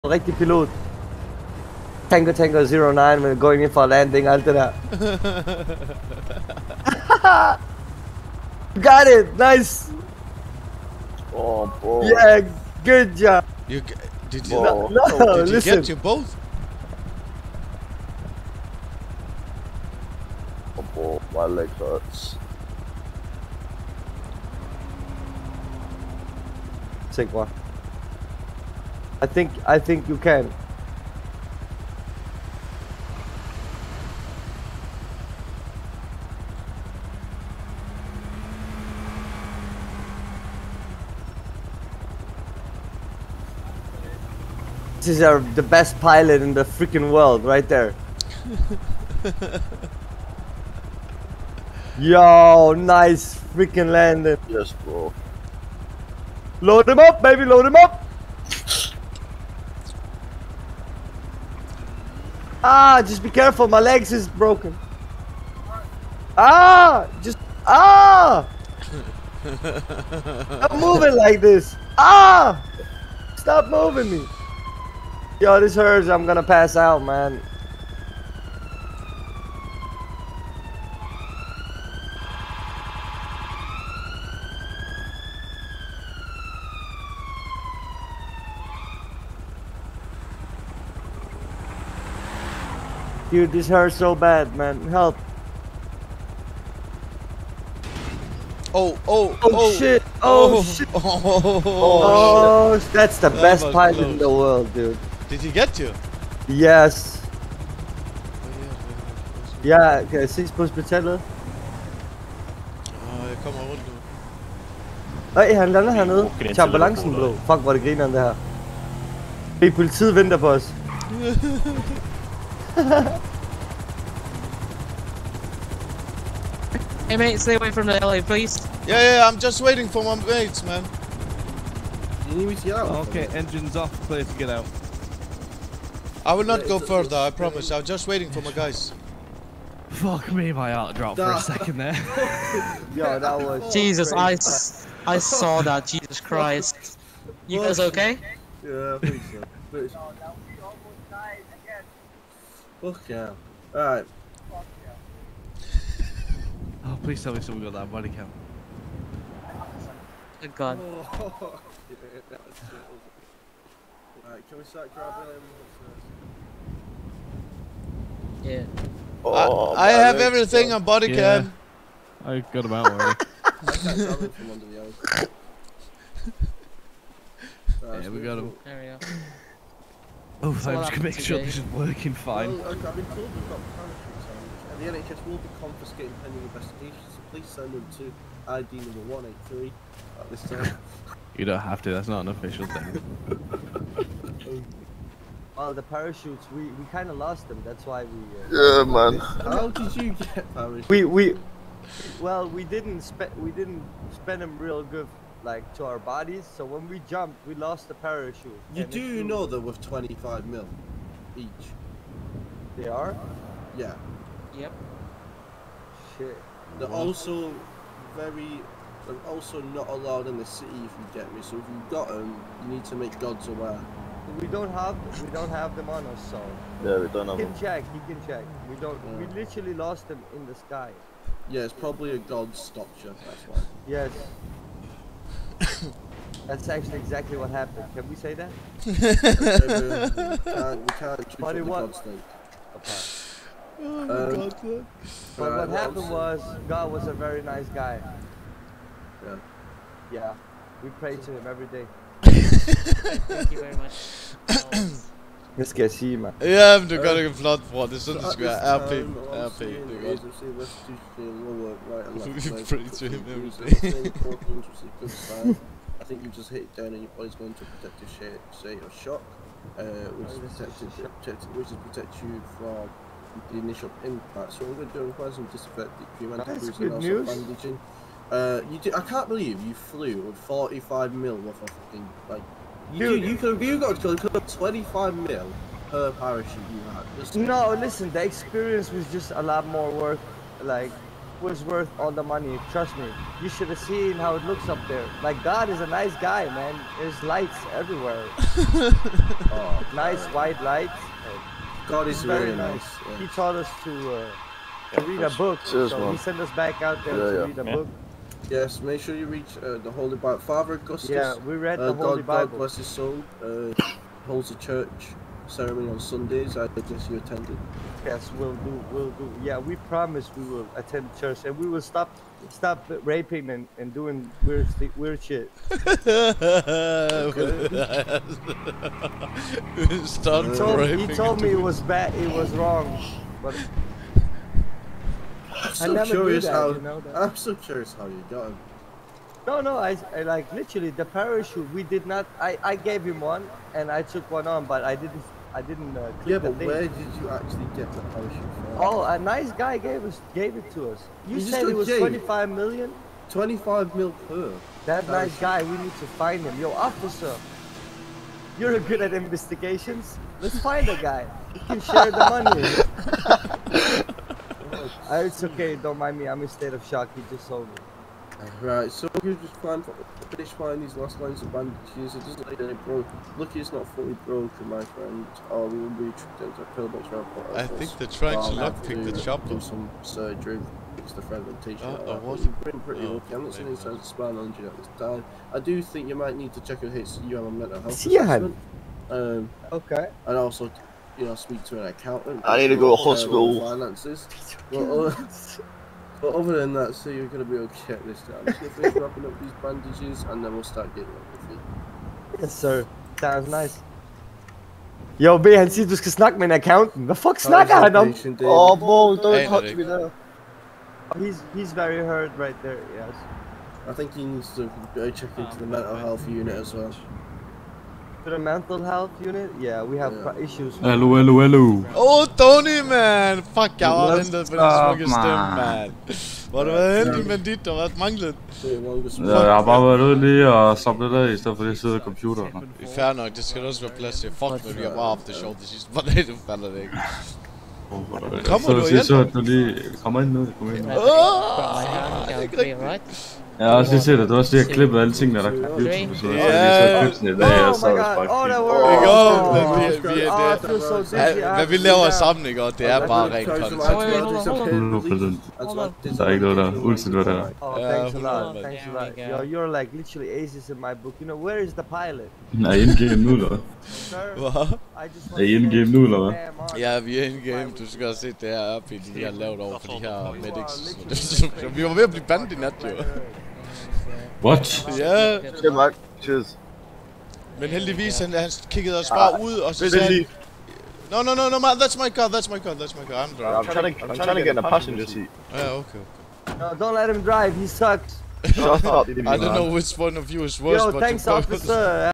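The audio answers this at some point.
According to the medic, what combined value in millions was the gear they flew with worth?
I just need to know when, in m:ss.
4:40.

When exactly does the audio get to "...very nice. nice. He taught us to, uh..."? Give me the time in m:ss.
5:02.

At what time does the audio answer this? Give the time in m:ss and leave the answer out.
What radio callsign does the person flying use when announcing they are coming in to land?
0:02.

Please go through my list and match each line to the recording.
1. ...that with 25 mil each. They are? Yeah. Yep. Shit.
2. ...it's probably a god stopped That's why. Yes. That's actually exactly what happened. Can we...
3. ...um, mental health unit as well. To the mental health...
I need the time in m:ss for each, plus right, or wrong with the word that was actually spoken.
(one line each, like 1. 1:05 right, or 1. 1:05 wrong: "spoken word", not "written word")
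1. 3:29 right
2. 3:51 right
3. 6:55 right.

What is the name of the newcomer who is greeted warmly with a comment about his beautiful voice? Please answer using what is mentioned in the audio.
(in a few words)
Tony.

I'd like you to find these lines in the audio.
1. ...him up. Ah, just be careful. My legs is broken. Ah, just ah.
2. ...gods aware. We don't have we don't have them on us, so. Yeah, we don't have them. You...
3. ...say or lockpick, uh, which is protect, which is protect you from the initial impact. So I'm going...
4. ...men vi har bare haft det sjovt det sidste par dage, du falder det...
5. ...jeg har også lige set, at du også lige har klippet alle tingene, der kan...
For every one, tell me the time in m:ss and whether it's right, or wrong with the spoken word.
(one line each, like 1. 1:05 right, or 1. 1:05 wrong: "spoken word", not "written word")
1. 0:57 right
2. 3:43 right
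3. 4:28 wrong: "shock", not "lockpick"
4. 7:14 right
5. 7:23 right.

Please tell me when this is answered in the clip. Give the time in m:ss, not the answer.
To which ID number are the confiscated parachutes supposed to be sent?
3:08.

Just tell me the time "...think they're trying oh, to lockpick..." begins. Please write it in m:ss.
6:17.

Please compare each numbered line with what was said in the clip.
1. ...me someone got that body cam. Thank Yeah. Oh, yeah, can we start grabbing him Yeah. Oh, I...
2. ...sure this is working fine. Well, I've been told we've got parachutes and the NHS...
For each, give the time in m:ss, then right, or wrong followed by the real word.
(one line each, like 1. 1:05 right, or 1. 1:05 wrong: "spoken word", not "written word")
1. 2:37 wrong: "God", not "Yeah"
2. 3:01 right.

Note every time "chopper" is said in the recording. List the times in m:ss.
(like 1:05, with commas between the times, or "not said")
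6:19.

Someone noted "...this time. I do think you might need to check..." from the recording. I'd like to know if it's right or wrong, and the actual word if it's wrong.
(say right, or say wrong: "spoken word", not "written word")
right.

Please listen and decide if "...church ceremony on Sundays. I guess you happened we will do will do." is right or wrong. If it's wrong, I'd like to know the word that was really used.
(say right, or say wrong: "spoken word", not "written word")
wrong: "attended", not "happened".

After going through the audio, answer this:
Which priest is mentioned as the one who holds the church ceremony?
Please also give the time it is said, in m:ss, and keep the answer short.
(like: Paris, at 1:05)
Father Augustus, at 5:10.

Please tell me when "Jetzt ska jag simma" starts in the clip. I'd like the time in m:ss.
4:15.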